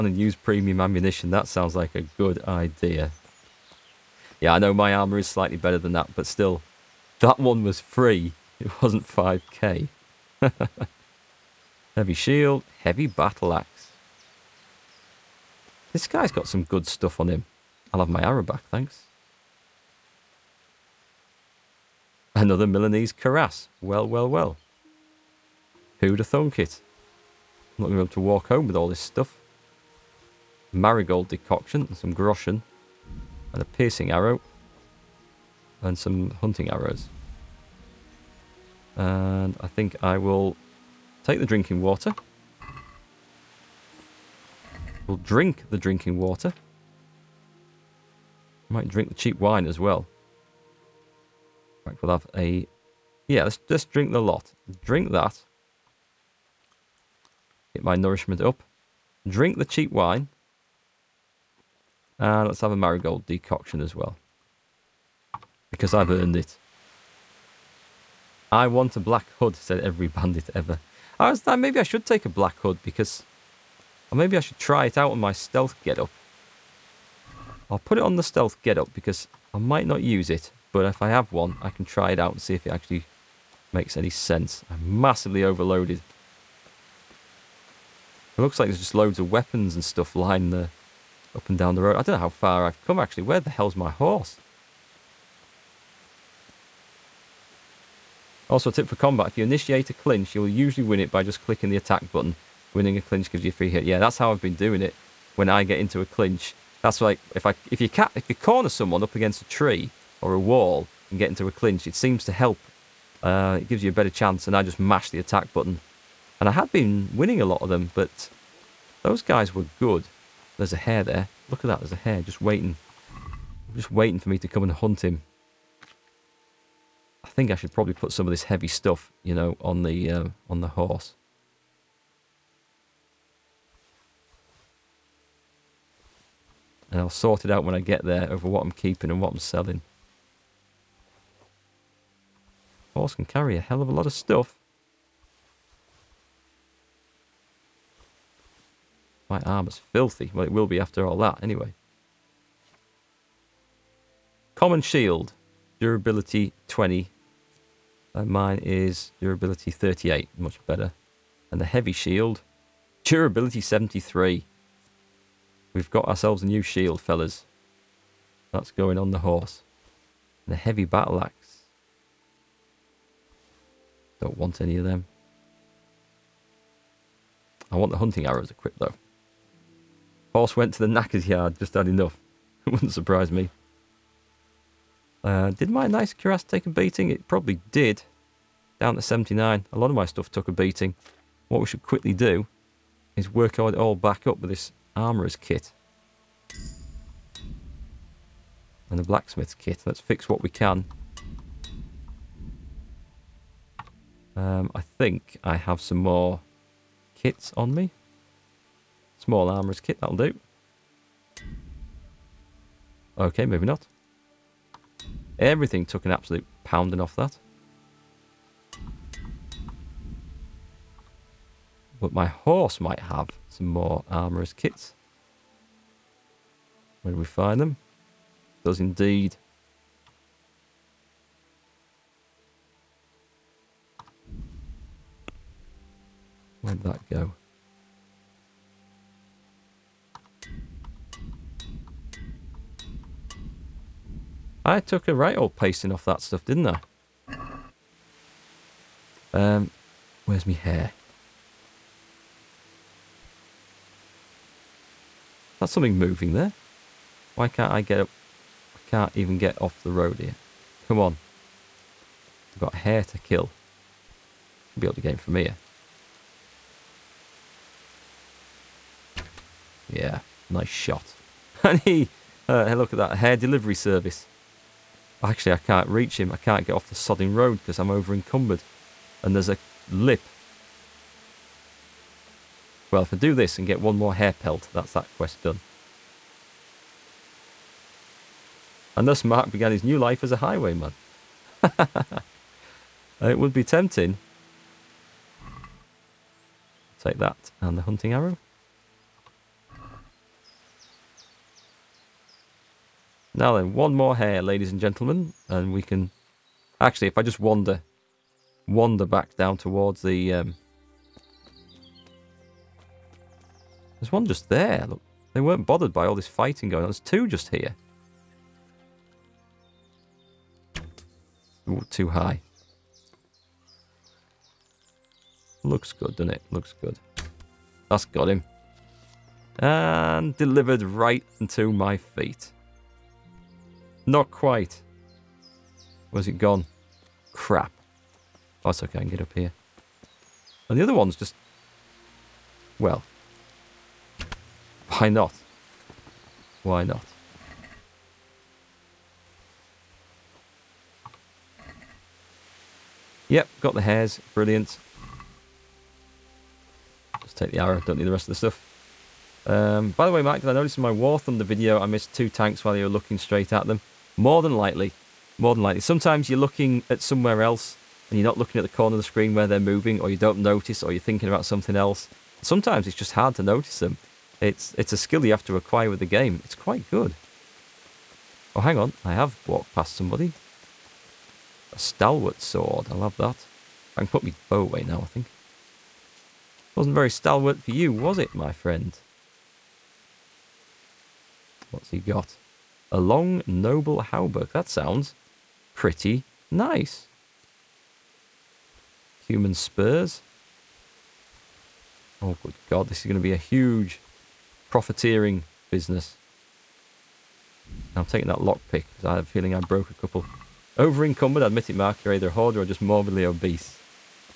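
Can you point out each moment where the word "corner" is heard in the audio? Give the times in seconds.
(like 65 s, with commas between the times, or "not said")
108 s, 368 s.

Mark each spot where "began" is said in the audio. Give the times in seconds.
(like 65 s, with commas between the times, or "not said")
289 s.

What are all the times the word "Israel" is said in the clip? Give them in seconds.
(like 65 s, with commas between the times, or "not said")
not said.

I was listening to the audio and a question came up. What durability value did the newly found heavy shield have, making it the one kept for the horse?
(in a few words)
73.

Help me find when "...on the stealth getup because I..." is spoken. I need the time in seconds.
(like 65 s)
78 s.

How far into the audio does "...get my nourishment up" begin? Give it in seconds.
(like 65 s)
57 s.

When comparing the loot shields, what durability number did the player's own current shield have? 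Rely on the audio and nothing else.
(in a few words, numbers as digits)
38.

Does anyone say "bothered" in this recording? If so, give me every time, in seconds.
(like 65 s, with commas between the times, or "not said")
315 s.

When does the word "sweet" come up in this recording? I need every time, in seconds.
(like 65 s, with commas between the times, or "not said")
not said.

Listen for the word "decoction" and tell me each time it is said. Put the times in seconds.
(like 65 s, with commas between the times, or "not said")
31 s, 63 s.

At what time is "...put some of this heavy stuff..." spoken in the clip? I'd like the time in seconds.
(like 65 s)
127 s.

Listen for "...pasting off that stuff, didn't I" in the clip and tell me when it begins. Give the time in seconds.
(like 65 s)
245 s.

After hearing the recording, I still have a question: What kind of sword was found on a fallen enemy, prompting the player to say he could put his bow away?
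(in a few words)
stalwart sword.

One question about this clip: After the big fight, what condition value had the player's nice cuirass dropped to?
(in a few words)
79.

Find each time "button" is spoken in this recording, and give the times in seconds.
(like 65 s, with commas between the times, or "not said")
102 s, 115 s.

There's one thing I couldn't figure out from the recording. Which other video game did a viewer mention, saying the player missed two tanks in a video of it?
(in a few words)
War Thunder.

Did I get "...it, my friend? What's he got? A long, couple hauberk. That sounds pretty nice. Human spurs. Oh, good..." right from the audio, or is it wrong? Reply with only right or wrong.
wrong.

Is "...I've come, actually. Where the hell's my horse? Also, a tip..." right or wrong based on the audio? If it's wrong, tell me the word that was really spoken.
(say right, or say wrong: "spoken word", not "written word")
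right.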